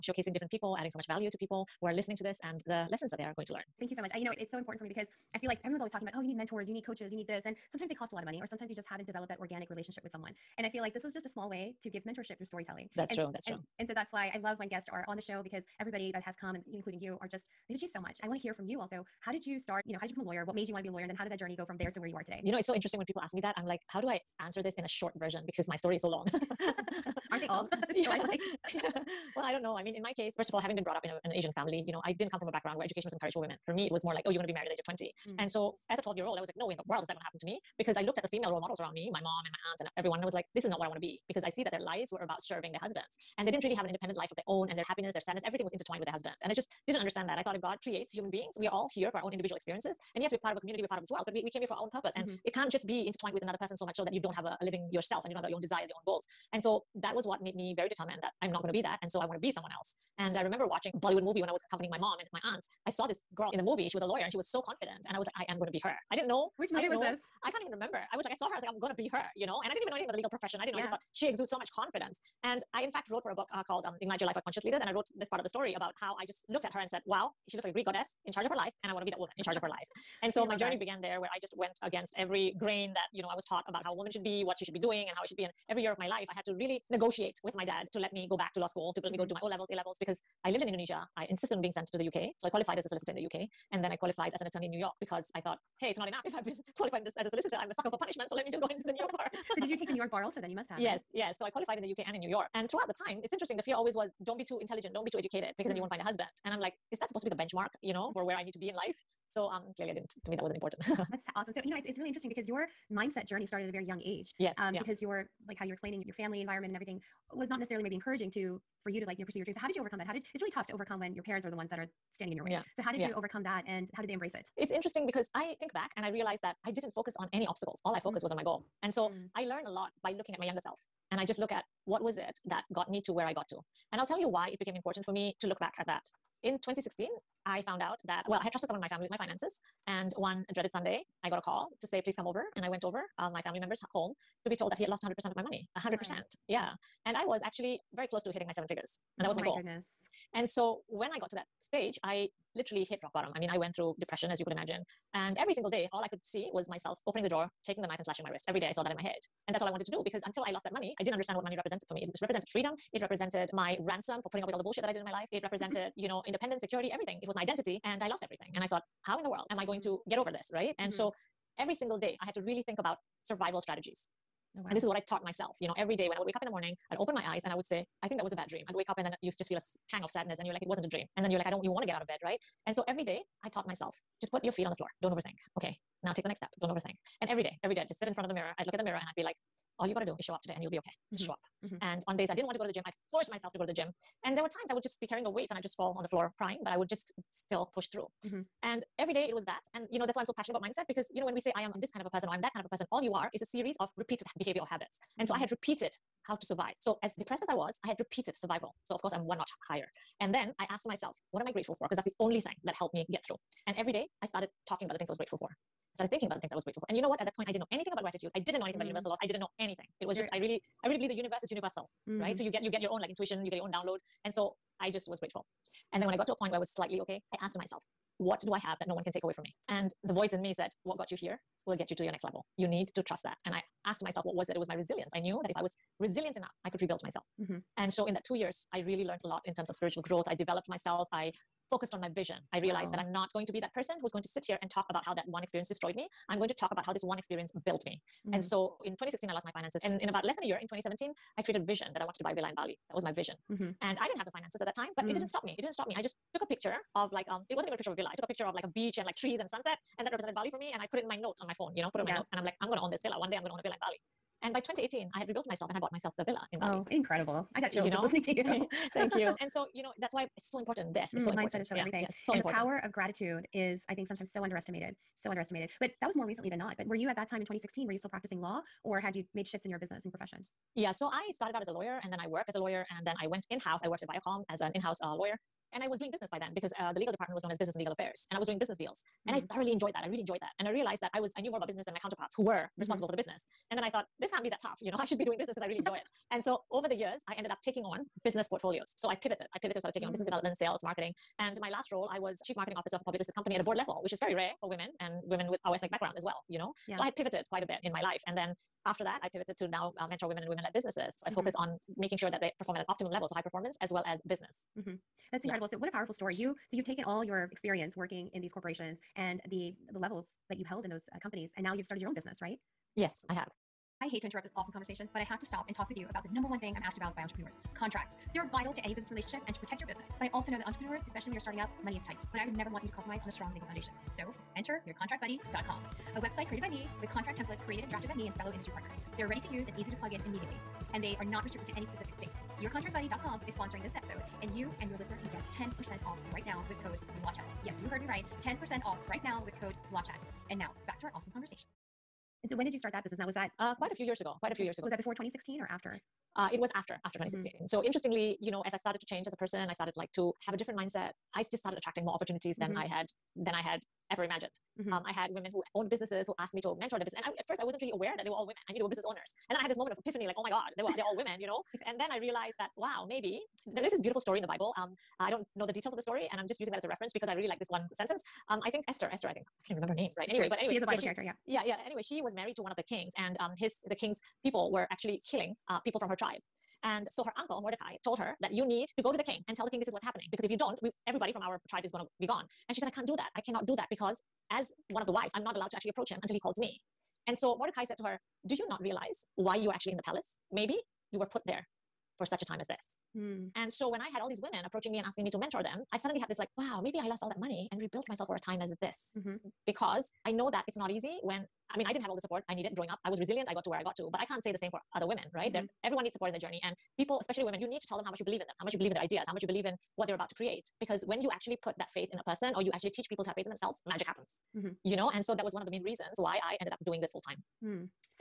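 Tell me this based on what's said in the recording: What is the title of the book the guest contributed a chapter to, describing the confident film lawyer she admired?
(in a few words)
Ignite Your Life for Conscious Leaders.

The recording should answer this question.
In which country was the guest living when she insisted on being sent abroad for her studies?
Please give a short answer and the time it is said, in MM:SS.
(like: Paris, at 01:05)
Indonesia, at 01:30.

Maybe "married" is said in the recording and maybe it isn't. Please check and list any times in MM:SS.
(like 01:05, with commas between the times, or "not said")
00:34, 06:22.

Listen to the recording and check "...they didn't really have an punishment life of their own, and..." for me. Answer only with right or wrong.
wrong.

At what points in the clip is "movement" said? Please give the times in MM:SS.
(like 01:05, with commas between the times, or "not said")
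not said.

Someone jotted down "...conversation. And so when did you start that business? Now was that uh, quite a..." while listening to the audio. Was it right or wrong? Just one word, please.
right.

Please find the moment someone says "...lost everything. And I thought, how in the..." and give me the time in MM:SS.
02:48.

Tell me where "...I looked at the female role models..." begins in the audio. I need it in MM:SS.
00:37.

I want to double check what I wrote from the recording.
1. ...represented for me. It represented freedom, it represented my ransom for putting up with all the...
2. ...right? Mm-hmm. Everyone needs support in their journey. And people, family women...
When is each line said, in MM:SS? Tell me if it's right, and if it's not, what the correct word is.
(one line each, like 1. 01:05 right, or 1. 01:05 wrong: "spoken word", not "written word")
1. 02:41 right
2. 06:55 wrong: "especially", not "family".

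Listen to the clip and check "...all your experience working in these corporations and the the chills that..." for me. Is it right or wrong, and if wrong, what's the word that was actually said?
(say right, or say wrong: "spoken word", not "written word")
wrong: "levels", not "chills".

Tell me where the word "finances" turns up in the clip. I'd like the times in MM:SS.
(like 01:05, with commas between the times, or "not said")
02:19, 04:09, 04:14.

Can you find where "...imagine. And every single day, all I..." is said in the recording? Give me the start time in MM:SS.
02:34.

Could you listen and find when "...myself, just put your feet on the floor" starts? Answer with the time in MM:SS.
03:03.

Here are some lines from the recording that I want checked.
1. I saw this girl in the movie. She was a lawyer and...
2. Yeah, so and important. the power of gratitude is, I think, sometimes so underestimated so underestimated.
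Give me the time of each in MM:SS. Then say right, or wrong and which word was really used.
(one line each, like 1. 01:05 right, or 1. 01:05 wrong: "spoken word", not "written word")
1. 01:02 right
2. 04:32 right.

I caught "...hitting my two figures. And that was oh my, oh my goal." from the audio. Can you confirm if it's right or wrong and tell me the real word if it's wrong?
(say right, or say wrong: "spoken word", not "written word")
wrong: "seven", not "two".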